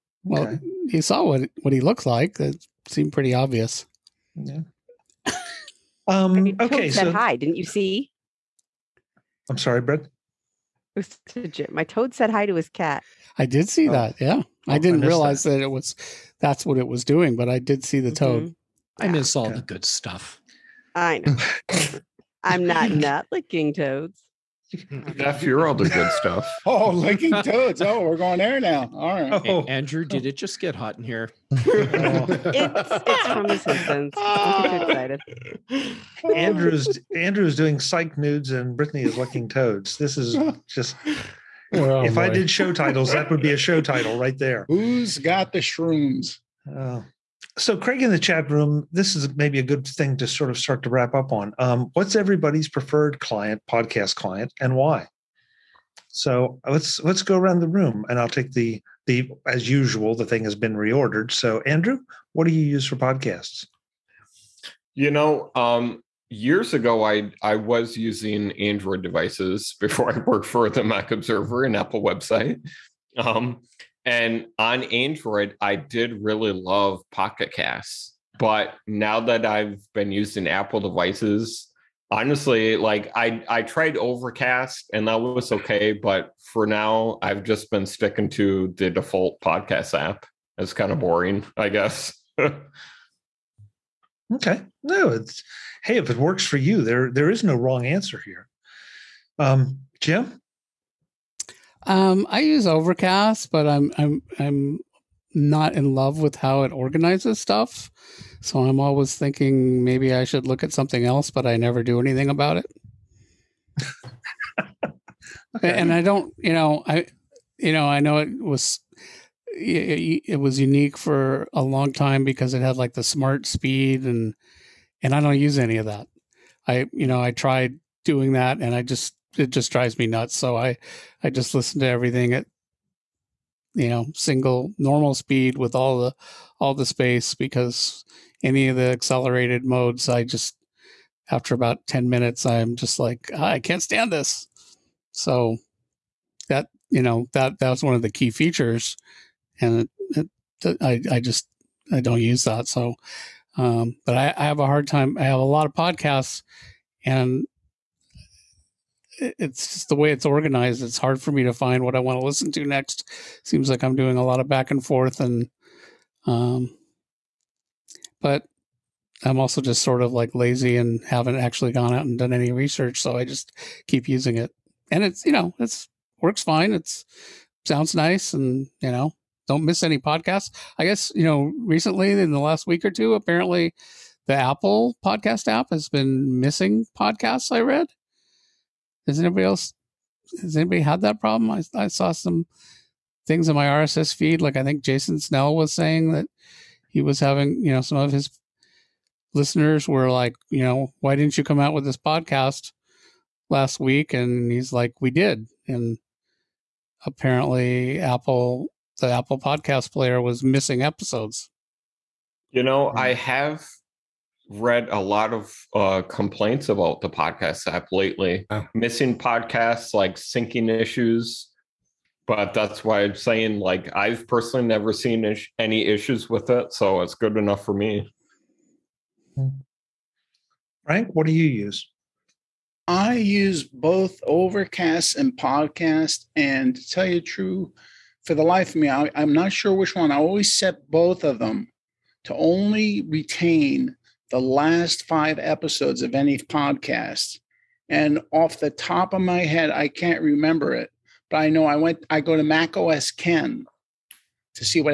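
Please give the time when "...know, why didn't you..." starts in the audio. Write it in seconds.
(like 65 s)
200 s.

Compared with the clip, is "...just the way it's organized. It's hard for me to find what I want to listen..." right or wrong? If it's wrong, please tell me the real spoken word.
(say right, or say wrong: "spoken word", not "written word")
right.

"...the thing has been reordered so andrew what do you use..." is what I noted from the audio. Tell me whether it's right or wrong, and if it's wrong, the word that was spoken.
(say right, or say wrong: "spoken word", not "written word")
right.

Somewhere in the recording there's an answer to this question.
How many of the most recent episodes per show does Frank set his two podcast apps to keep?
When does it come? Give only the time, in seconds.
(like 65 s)
245 s.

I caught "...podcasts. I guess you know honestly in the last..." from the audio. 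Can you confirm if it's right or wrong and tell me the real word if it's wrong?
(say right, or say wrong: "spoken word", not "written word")
wrong: "recently", not "honestly".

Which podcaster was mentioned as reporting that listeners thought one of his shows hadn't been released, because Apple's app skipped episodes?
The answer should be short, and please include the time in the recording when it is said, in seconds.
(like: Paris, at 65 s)
Jason Snell, at 194 s.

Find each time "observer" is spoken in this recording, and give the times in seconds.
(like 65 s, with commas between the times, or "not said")
71 s.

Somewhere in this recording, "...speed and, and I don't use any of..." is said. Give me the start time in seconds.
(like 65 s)
123 s.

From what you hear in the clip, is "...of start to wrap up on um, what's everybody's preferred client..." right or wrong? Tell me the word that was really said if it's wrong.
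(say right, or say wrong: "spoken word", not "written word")
right.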